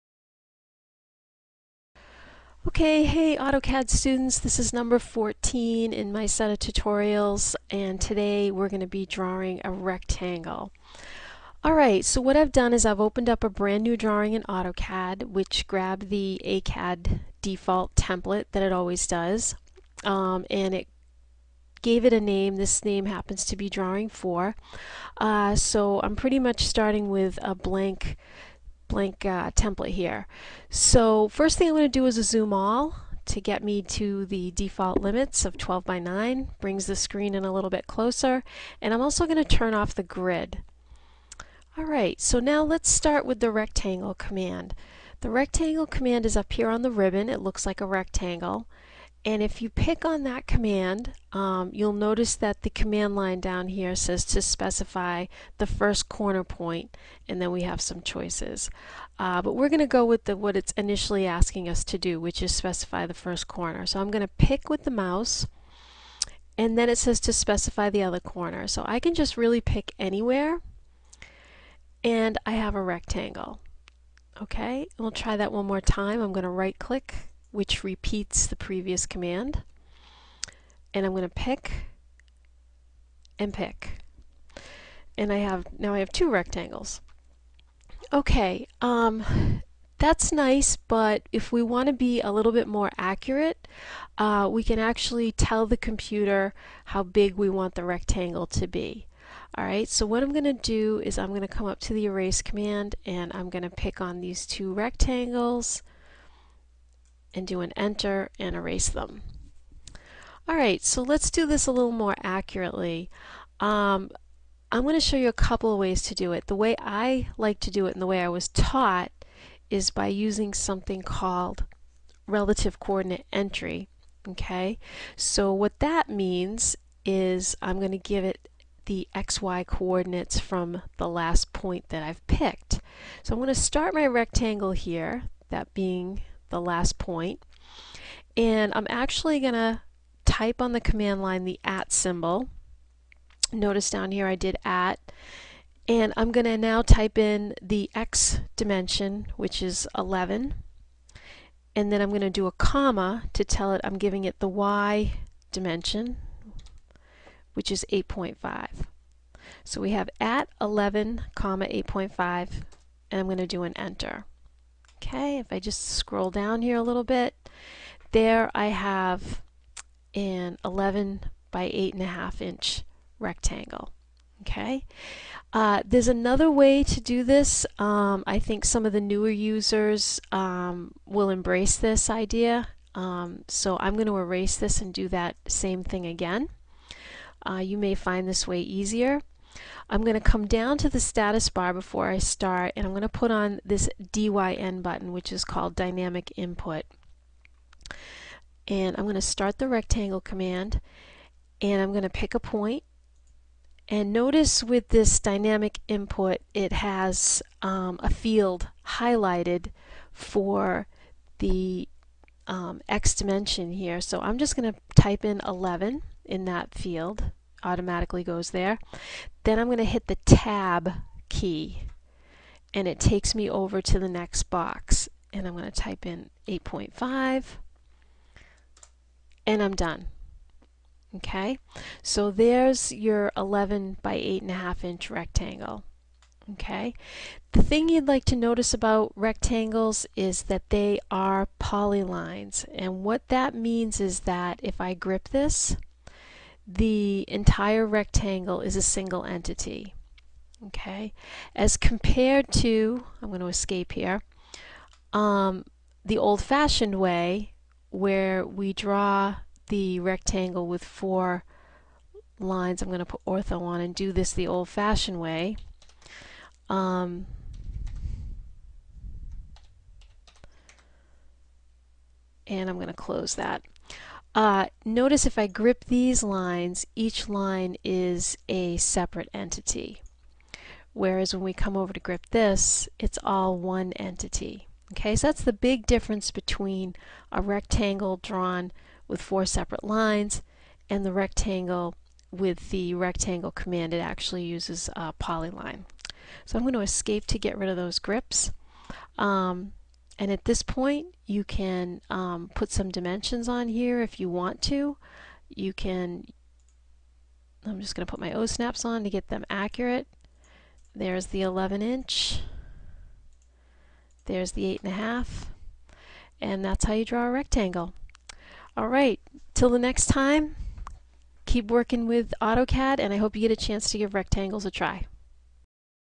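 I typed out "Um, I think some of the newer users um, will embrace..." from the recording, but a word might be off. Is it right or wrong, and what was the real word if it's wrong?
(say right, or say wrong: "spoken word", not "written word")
right.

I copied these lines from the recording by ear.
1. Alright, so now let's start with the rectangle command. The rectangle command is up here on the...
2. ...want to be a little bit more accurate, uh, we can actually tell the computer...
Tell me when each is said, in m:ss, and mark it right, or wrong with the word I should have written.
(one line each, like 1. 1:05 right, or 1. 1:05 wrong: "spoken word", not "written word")
1. 0:41 right
2. 1:31 right.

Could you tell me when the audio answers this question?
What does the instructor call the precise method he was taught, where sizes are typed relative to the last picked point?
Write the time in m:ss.
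2:02.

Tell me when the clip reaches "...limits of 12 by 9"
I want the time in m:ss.
0:34.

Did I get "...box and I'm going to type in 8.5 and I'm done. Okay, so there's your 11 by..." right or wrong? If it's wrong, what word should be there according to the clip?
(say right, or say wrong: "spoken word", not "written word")
right.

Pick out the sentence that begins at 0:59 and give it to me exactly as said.
Uh, but we're going to go with the, what it's initially asking us to do, which is specify the first corner.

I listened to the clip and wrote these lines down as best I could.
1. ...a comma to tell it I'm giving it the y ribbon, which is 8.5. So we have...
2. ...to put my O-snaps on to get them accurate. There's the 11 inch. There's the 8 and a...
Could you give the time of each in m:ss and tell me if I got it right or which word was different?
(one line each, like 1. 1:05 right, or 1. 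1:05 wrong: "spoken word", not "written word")
1. 2:32 wrong: "dimension", not "ribbon"
2. 5:08 right.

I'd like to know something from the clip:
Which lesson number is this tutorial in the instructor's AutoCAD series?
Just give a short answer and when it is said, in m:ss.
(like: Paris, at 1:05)
14, at 0:04.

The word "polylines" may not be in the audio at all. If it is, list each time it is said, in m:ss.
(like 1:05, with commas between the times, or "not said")
4:01, 4:55.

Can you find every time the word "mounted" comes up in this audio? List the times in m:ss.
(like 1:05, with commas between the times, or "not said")
not said.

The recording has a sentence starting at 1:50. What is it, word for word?
All right, so let's do this a little more accurately.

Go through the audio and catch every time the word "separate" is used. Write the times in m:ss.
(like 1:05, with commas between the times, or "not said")
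4:38, 4:49.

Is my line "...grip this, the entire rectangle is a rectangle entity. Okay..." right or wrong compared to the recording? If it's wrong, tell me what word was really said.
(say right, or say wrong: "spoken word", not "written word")
wrong: "single", not "rectangle".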